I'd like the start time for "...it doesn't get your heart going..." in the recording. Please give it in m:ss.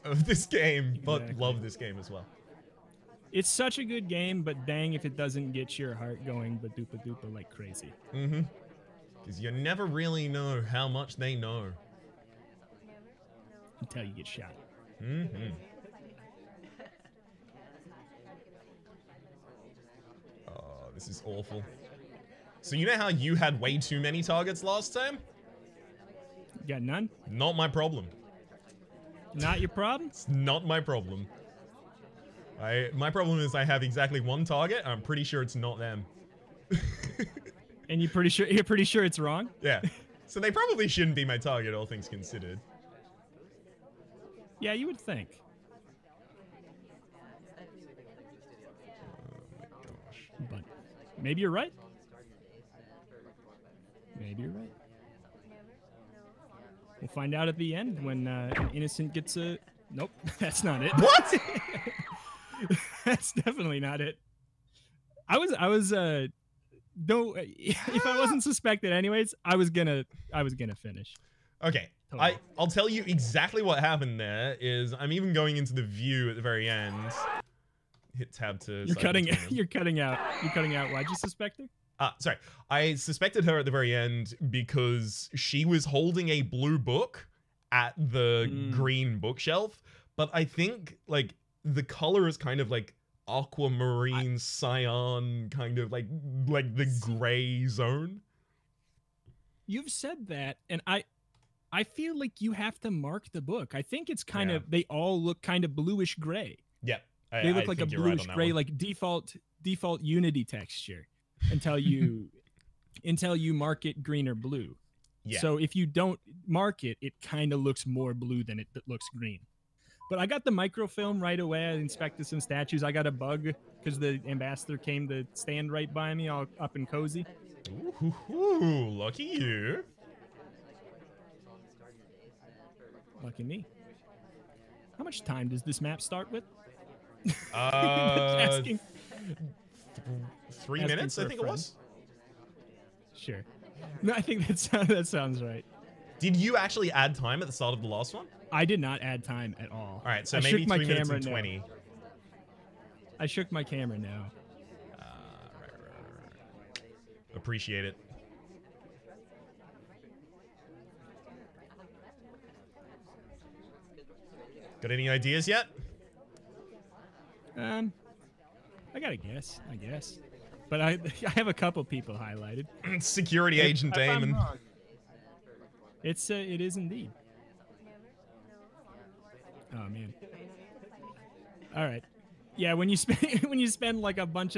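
0:05.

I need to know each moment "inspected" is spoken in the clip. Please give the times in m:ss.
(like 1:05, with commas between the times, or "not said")
2:01.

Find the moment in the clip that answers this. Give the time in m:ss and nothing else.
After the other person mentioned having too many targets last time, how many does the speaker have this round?
0:33.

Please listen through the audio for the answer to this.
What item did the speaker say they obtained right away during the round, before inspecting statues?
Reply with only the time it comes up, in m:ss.
2:00.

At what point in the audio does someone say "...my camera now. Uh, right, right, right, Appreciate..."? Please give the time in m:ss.
2:33.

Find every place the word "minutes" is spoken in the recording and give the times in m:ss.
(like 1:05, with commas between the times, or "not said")
2:20, 2:30.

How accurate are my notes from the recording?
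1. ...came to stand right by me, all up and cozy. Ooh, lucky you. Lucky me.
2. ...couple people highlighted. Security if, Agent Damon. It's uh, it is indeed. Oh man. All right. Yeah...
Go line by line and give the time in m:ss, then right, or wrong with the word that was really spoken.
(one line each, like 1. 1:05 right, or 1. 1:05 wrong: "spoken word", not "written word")
1. 2:04 right
2. 2:51 right.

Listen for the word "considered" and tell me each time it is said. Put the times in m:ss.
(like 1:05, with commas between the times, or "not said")
0:42.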